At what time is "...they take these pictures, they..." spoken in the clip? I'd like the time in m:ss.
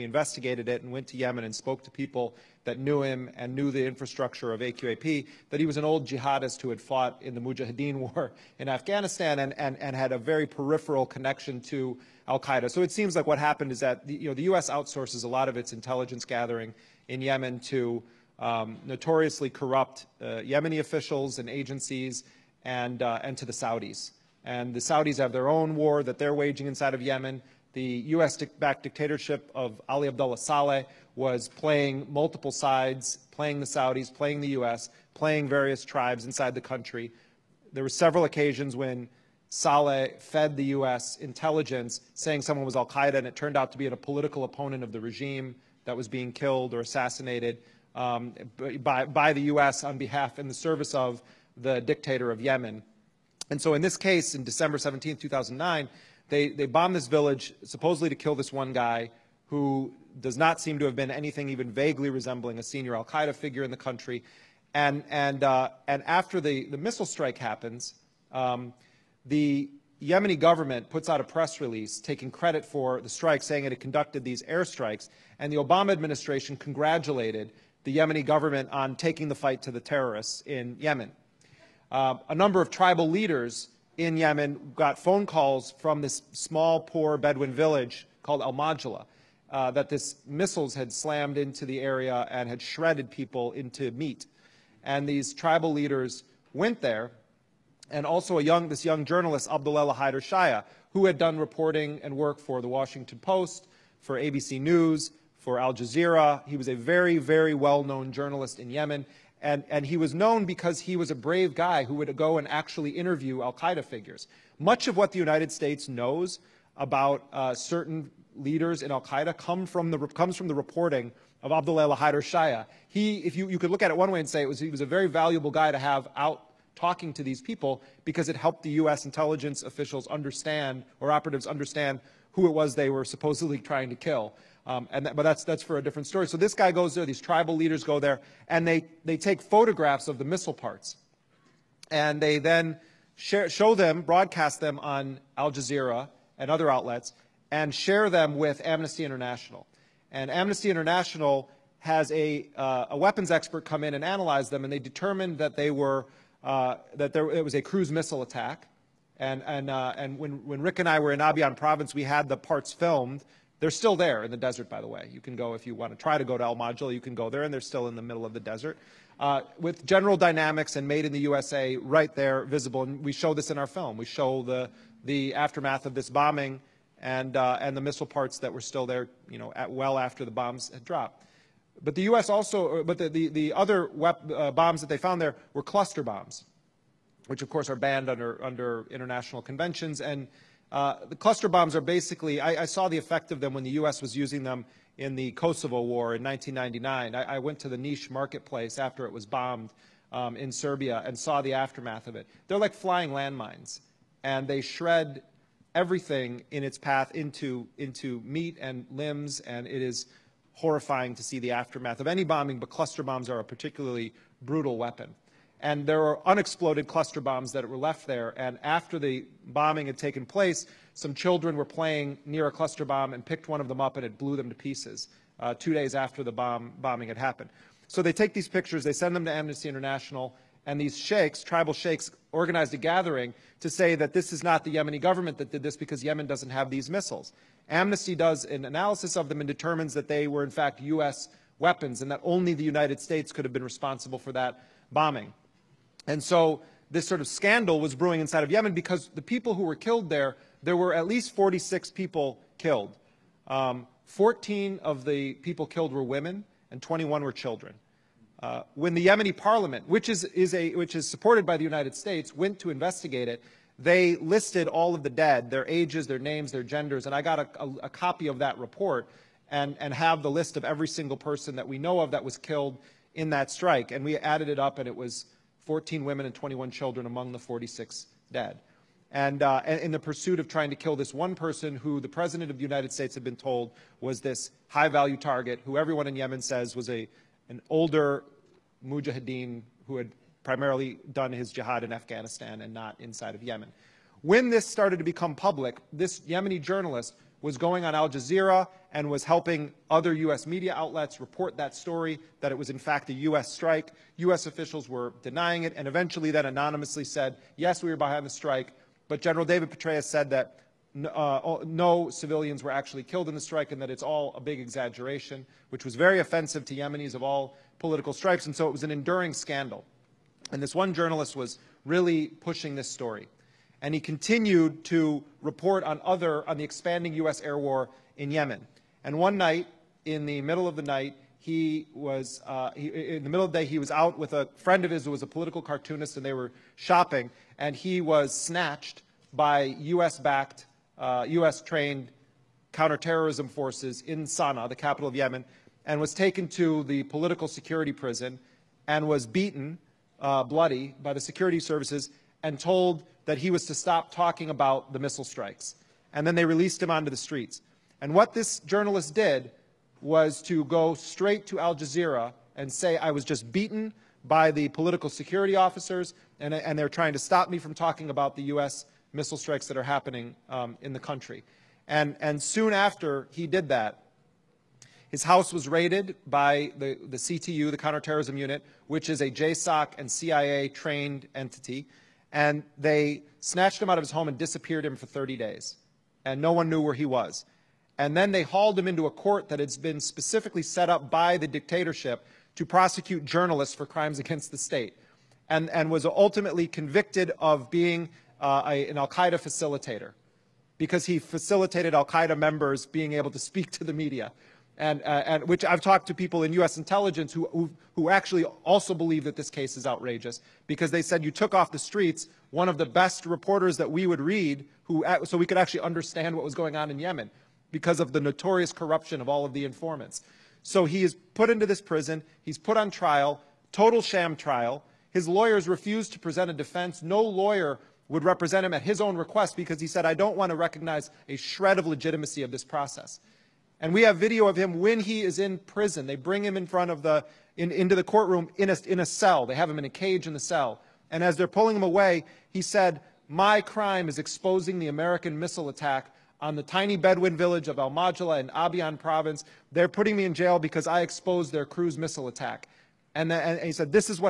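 3:48.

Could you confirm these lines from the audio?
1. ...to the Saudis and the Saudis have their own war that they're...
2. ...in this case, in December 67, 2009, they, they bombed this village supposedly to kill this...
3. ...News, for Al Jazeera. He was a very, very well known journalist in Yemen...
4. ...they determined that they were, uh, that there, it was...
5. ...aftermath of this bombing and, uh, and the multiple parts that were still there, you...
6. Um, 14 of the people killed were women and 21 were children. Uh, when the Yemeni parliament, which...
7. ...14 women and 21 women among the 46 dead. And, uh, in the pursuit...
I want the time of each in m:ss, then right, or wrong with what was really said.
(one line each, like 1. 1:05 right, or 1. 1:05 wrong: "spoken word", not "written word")
1. 0:23 right
2. 0:53 wrong: "17", not "67"
3. 1:44 right
4. 2:34 right
5. 2:55 wrong: "missile", not "multiple"
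6. 4:13 right
7. 4:35 wrong: "children", not "women".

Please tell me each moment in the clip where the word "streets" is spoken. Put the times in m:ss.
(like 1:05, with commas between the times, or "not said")
5:57, 6:51.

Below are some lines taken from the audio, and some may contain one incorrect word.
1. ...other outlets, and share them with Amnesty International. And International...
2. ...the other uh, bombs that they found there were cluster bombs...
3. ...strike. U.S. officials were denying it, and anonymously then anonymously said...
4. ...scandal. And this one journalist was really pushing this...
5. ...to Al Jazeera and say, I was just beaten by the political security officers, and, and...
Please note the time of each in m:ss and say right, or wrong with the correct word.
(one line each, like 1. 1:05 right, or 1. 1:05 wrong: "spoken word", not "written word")
1. 2:26 wrong: "Amnesty", not "International"
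2. 3:03 right
3. 5:03 wrong: "eventually", not "anonymously"
4. 5:19 right
5. 6:01 right.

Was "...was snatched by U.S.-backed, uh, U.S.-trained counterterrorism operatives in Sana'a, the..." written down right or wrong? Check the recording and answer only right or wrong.
wrong.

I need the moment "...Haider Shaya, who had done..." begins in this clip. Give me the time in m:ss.
1:39.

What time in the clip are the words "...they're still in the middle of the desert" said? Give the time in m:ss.
2:47.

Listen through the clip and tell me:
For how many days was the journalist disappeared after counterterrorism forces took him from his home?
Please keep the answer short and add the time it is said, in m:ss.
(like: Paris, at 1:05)
30, at 6:25.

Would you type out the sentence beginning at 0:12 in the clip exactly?
So it seems like what happened is that the, you know, the U.S.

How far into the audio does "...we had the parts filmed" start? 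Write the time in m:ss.
2:41.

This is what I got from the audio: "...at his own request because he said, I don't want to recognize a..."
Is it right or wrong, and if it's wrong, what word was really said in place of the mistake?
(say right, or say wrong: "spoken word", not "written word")
right.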